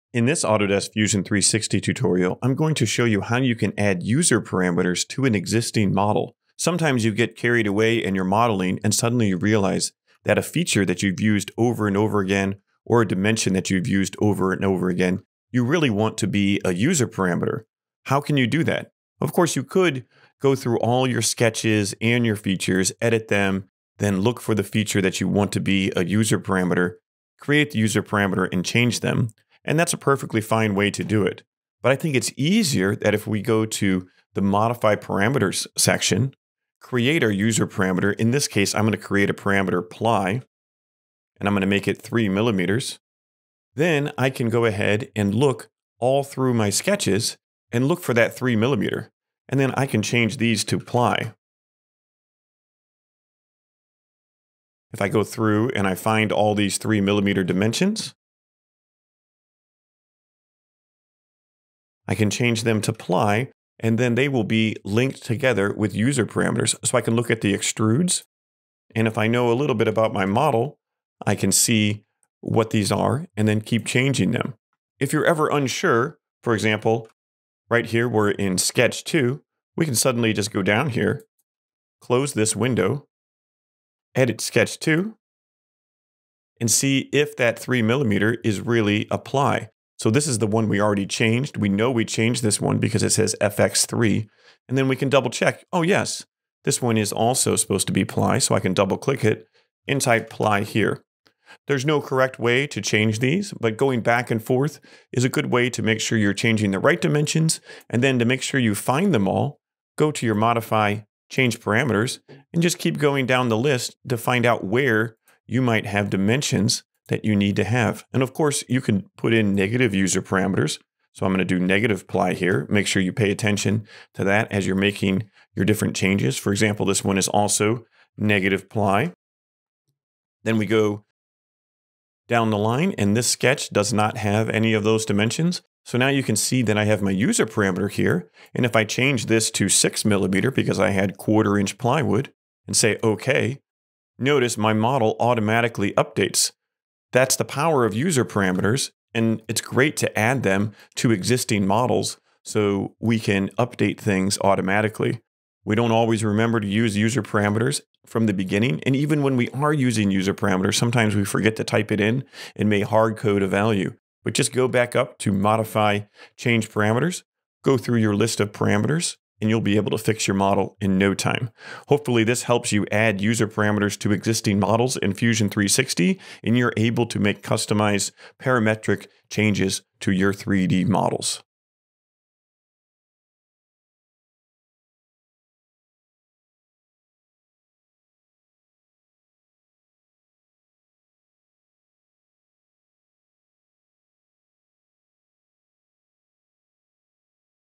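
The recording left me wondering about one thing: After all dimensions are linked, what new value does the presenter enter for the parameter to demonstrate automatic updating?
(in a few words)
6 millimeter.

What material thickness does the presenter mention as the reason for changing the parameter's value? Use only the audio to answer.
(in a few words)
quarter inch plywood.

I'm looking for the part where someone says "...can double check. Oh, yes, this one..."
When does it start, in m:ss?
1:34.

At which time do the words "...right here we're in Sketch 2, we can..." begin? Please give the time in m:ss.
1:17.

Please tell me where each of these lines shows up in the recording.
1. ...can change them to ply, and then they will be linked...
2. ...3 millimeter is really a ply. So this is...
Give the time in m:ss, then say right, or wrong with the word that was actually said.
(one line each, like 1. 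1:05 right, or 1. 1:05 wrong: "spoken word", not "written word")
1. 1:02 right
2. 1:27 right.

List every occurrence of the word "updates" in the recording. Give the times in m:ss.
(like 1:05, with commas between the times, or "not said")
2:25, 2:33.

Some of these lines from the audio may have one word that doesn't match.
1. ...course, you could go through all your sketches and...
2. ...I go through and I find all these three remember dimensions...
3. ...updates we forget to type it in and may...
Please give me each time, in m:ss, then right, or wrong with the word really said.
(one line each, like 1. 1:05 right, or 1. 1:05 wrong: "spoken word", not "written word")
1. 0:19 right
2. 0:55 wrong: "millimeter", not "remember"
3. 2:40 wrong: "sometimes", not "updates".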